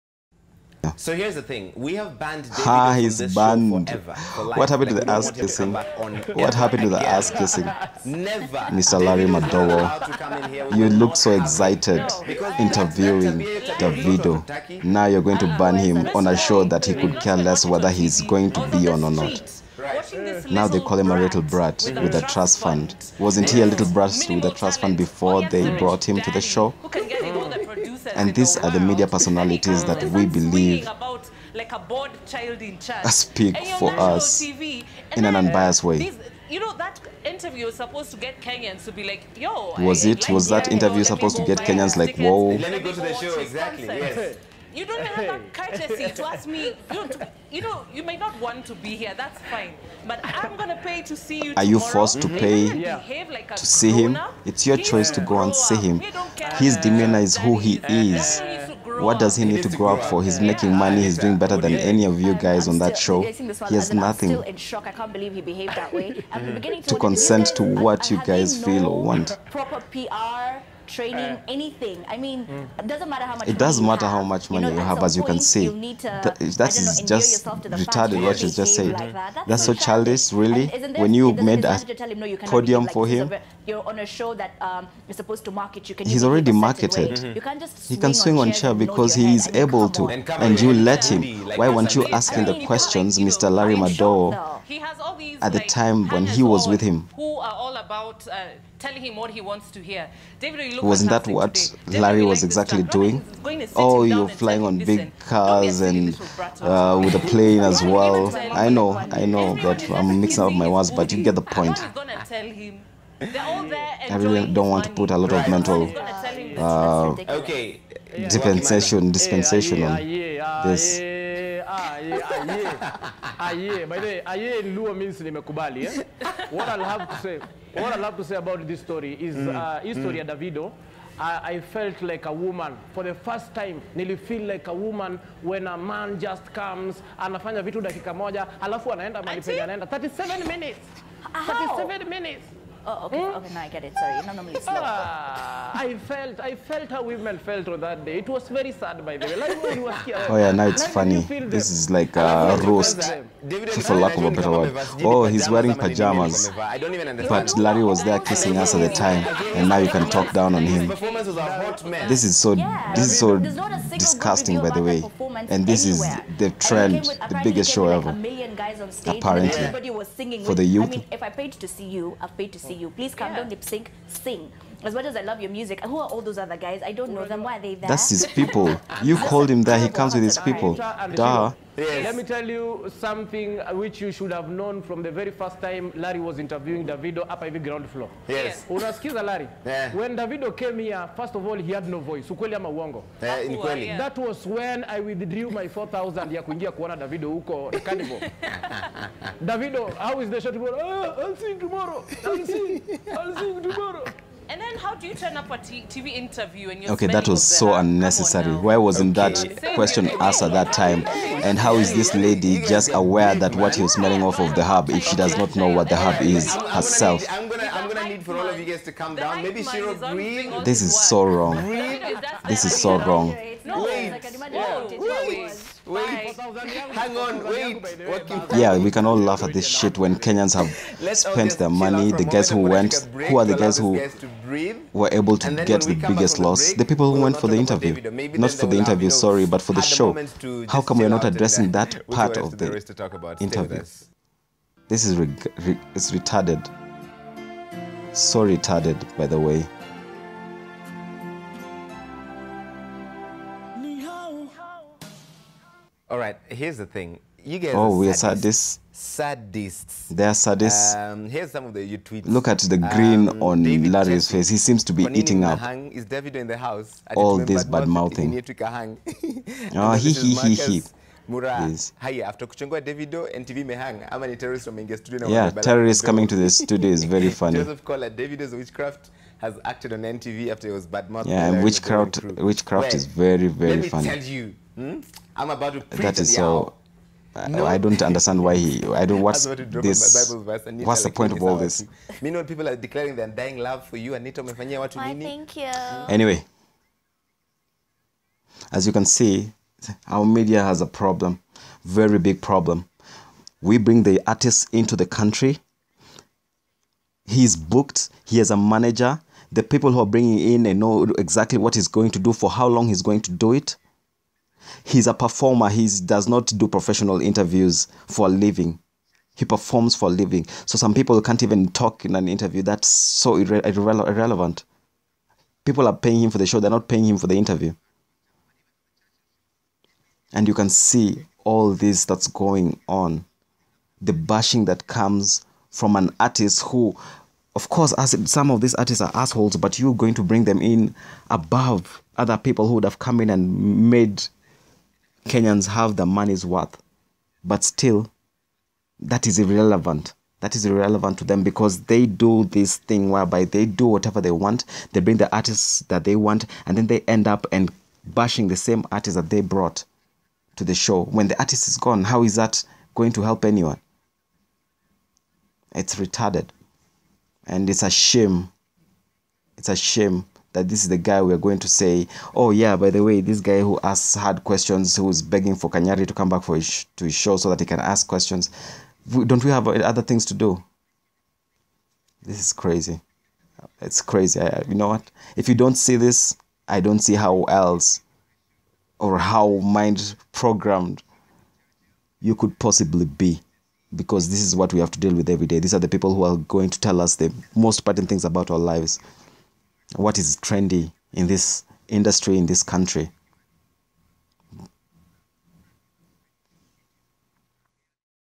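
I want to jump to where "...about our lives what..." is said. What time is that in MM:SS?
06:38.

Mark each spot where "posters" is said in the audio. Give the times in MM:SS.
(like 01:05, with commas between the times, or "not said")
not said.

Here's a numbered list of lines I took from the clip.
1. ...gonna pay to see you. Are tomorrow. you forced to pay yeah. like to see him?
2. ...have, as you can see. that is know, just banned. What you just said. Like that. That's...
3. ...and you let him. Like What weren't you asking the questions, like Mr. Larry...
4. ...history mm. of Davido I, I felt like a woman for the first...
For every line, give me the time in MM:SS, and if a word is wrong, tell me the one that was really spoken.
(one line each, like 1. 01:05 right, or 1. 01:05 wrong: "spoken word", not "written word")
1. 00:50 right
2. 01:14 wrong: "retarded", not "banned"
3. 01:30 wrong: "Why", not "What"
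4. 02:09 right.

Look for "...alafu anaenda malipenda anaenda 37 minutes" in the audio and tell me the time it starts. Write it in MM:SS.
02:18.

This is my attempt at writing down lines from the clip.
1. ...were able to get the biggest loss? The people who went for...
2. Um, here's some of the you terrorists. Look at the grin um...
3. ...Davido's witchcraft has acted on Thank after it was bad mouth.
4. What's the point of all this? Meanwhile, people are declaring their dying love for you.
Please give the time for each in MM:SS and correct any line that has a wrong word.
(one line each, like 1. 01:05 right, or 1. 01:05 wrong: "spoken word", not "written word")
1. 03:54 right
2. 04:20 wrong: "tweets", not "terrorists"
3. 04:38 wrong: "NTV", not "Thank"
4. 04:50 right.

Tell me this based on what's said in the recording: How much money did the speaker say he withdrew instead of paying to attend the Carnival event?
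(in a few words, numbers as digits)
4000.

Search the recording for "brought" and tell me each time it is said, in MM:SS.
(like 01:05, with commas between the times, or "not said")
00:25, 05:59.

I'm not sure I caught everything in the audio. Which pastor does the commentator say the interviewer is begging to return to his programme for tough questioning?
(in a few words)
Kanyari.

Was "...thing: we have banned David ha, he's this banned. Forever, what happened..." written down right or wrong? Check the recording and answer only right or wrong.
right.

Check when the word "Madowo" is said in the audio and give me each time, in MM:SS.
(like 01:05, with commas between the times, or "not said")
00:09, 01:33.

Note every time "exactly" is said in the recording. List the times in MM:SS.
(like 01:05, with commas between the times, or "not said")
00:43, 01:42, 05:11.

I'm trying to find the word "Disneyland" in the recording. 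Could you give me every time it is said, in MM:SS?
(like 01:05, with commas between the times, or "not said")
not said.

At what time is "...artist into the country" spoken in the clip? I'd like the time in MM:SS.
05:04.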